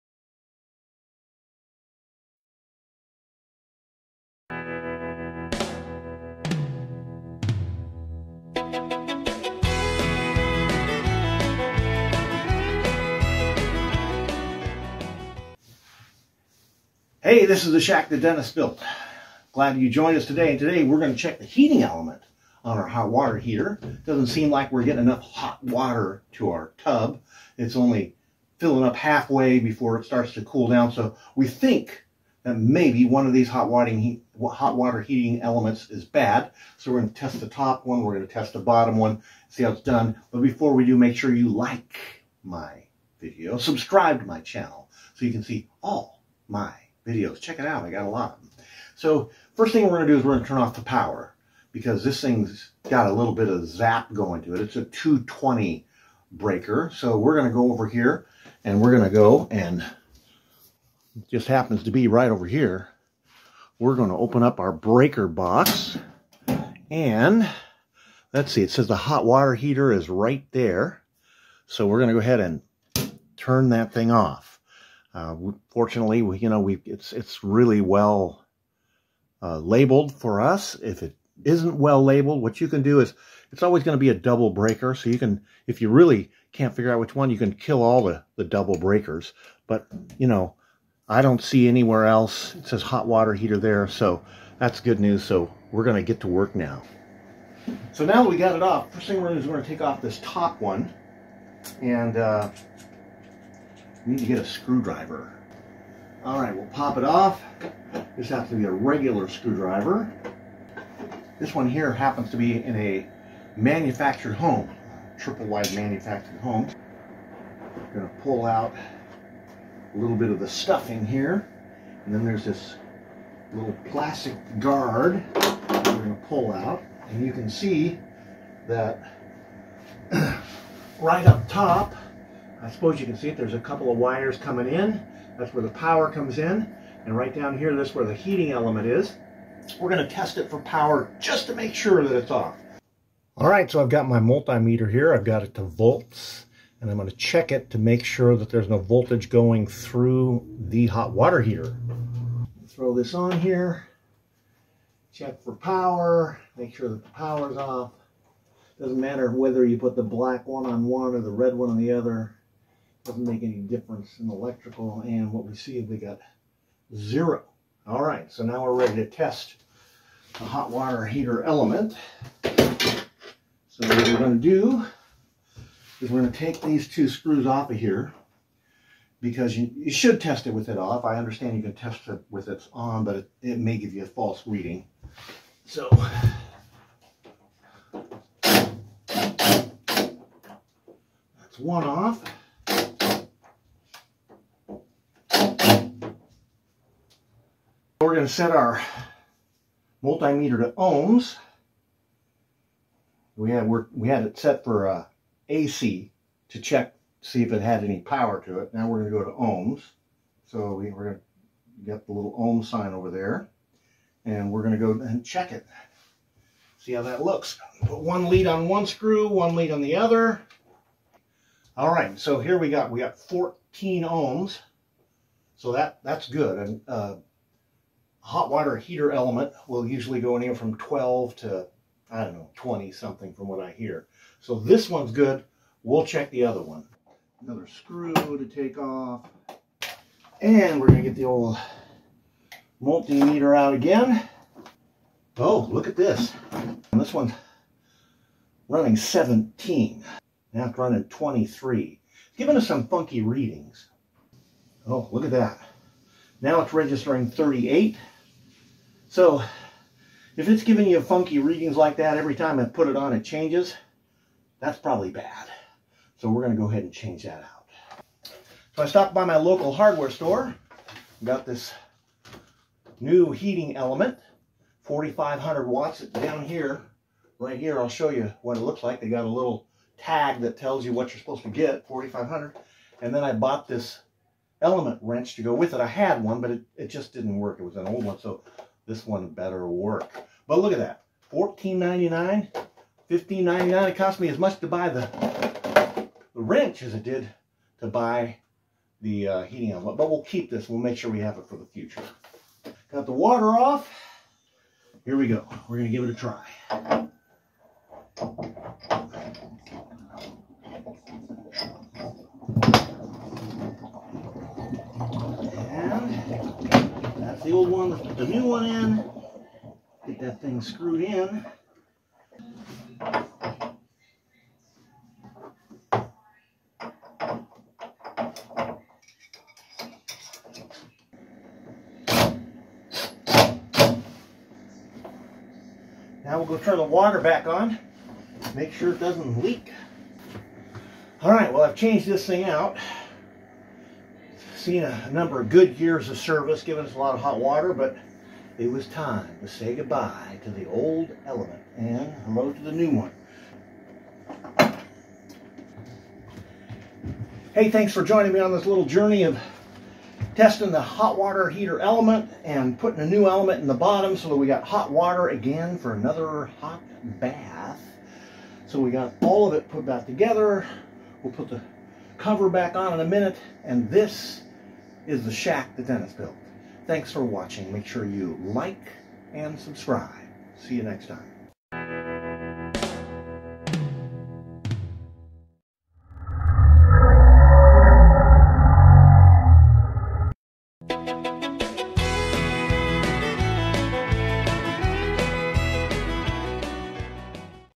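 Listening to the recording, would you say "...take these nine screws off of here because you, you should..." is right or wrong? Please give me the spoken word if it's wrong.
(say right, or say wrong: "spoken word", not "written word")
wrong: "two", not "nine".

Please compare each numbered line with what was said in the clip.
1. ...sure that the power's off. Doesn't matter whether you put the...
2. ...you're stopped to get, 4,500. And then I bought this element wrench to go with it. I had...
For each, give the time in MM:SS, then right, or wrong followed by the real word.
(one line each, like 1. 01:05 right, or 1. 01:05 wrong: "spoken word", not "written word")
1. 02:36 right
2. 04:41 wrong: "supposed", not "stopped".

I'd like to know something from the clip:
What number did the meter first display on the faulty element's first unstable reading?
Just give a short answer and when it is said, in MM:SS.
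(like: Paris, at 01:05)
17, at 04:08.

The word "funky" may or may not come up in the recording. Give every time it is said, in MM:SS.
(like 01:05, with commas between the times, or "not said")
04:12, 04:21.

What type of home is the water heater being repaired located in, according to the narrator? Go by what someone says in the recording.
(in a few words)
Triple wide manufactured home.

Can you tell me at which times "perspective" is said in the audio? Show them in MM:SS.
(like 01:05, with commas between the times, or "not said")
not said.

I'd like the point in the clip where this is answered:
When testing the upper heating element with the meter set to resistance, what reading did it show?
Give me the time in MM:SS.
03:43.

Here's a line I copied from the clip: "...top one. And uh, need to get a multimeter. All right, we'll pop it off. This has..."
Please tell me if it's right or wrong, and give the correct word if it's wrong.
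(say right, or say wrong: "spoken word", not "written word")
wrong: "screwdriver", not "multimeter".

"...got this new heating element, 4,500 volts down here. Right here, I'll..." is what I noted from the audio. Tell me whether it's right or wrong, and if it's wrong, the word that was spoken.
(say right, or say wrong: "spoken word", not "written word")
wrong: "watts", not "volts".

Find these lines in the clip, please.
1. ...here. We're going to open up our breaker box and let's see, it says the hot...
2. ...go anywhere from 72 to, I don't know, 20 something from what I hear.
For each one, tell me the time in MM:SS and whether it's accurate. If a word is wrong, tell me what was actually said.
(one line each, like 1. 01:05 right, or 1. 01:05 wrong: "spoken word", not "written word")
1. 01:02 right
2. 03:50 wrong: "12", not "72".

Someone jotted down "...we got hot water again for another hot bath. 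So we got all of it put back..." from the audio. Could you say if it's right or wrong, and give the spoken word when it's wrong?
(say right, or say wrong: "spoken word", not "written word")
right.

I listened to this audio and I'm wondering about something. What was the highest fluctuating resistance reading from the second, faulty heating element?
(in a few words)
38.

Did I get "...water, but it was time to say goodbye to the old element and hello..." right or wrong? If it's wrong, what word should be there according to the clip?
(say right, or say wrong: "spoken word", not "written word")
right.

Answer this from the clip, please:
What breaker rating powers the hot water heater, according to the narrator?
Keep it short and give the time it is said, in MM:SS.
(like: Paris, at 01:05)
220, at 00:54.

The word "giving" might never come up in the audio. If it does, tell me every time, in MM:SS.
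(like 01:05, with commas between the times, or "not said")
04:12, 04:20, 05:46.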